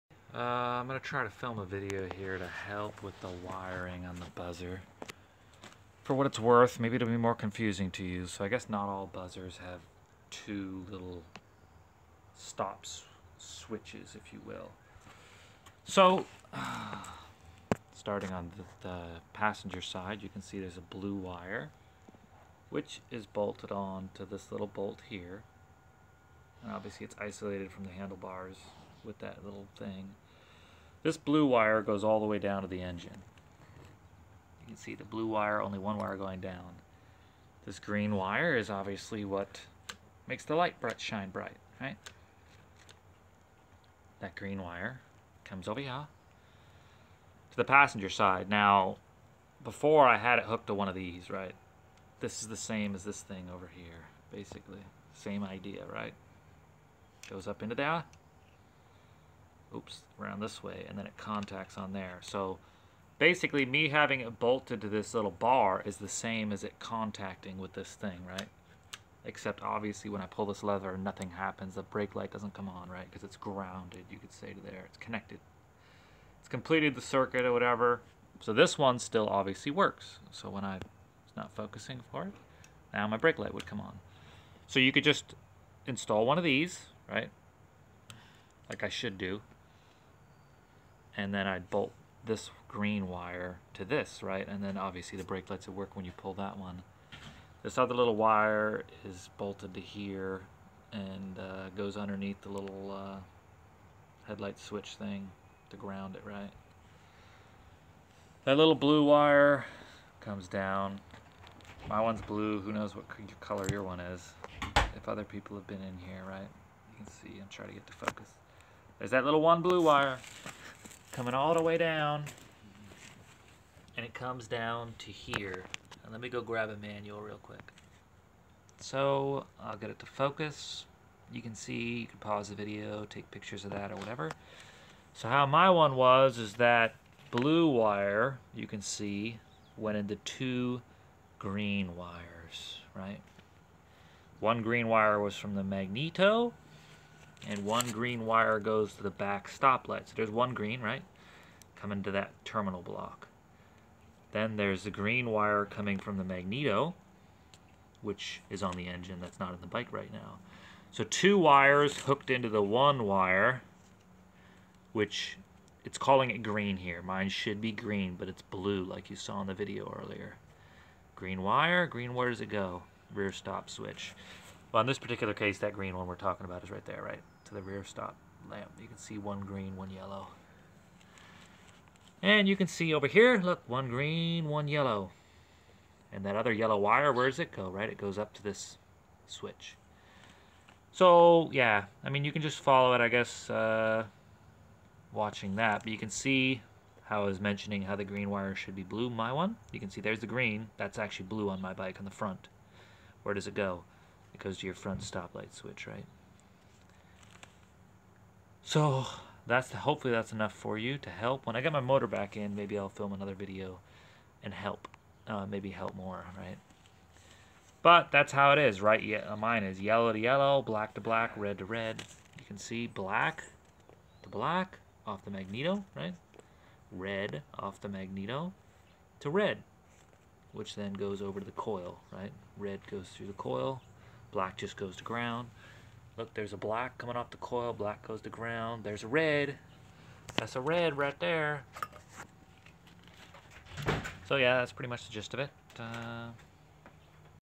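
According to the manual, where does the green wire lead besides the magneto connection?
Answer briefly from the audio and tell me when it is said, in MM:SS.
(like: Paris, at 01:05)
Rear stop switch, at 02:53.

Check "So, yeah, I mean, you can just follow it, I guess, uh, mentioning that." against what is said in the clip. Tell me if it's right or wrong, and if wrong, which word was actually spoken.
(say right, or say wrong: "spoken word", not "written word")
wrong: "watching", not "mentioning".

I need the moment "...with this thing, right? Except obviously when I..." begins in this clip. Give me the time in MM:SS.
01:07.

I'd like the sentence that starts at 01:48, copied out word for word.
That little blue wire comes down.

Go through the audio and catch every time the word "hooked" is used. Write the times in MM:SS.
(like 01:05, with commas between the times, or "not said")
00:50, 02:42.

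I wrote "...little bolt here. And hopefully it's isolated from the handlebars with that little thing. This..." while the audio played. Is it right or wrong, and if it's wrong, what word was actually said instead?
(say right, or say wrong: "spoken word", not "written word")
wrong: "obviously", not "hopefully".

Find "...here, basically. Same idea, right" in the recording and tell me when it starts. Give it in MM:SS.
00:53.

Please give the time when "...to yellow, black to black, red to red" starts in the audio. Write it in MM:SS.
03:40.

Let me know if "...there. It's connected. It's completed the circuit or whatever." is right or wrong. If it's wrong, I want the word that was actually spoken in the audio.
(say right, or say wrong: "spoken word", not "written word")
right.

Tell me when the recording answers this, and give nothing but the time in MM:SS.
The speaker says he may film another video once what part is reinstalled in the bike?
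03:31.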